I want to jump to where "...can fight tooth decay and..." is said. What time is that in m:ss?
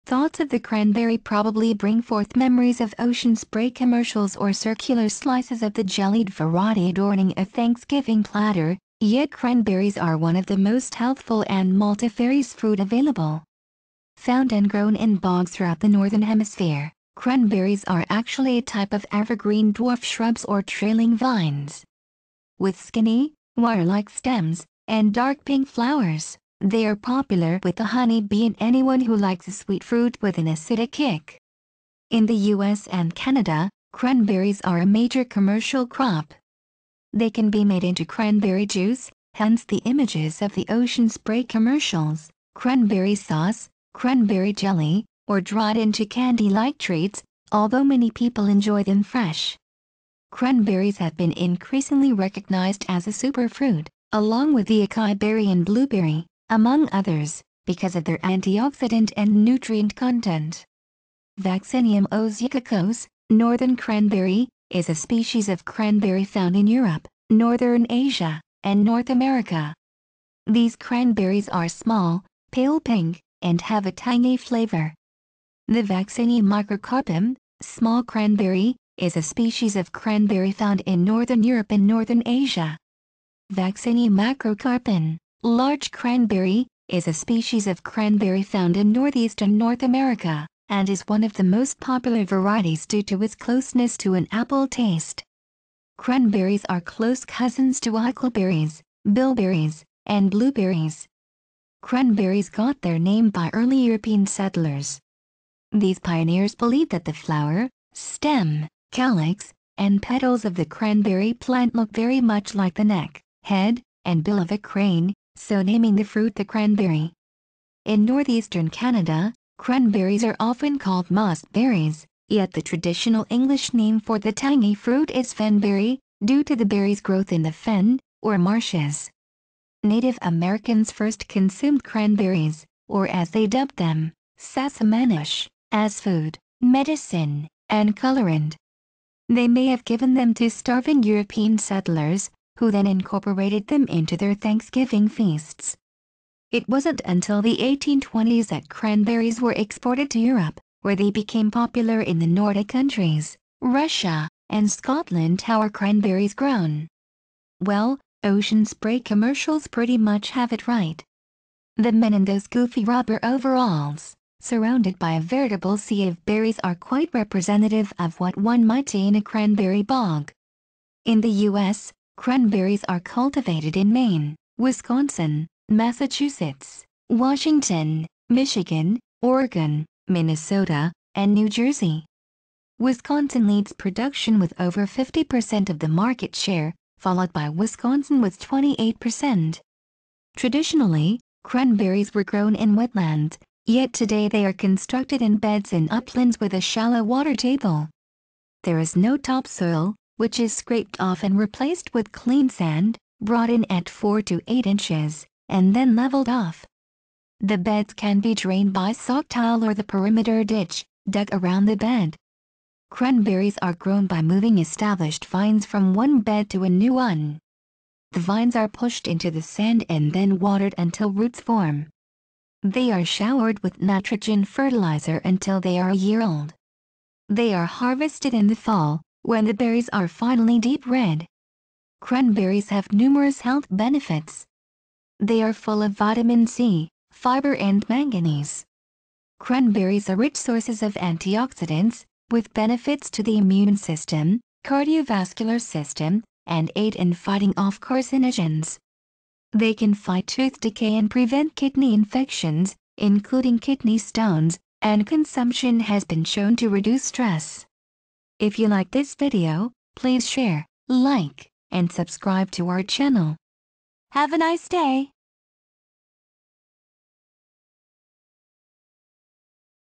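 4:09.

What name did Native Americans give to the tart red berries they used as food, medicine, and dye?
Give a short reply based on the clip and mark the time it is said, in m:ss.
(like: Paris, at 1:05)
Sassamanish, at 2:14.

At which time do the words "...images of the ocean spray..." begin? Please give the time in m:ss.
0:39.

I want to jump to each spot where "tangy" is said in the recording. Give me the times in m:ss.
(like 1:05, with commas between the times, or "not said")
1:13, 2:04.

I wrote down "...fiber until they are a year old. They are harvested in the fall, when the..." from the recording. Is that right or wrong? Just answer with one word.
wrong.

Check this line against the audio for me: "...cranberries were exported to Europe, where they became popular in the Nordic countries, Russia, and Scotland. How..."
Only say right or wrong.
right.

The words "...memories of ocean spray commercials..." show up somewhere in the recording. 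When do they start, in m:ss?
0:02.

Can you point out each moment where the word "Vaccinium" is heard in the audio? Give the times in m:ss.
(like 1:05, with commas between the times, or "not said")
1:01, 1:15, 1:23.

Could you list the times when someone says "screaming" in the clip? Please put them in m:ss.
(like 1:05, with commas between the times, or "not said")
not said.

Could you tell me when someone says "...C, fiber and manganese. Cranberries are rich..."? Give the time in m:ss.
3:56.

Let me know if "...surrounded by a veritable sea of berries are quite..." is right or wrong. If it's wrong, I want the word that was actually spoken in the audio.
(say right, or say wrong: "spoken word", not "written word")
right.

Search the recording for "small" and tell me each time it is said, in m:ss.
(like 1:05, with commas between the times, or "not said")
1:11, 1:17.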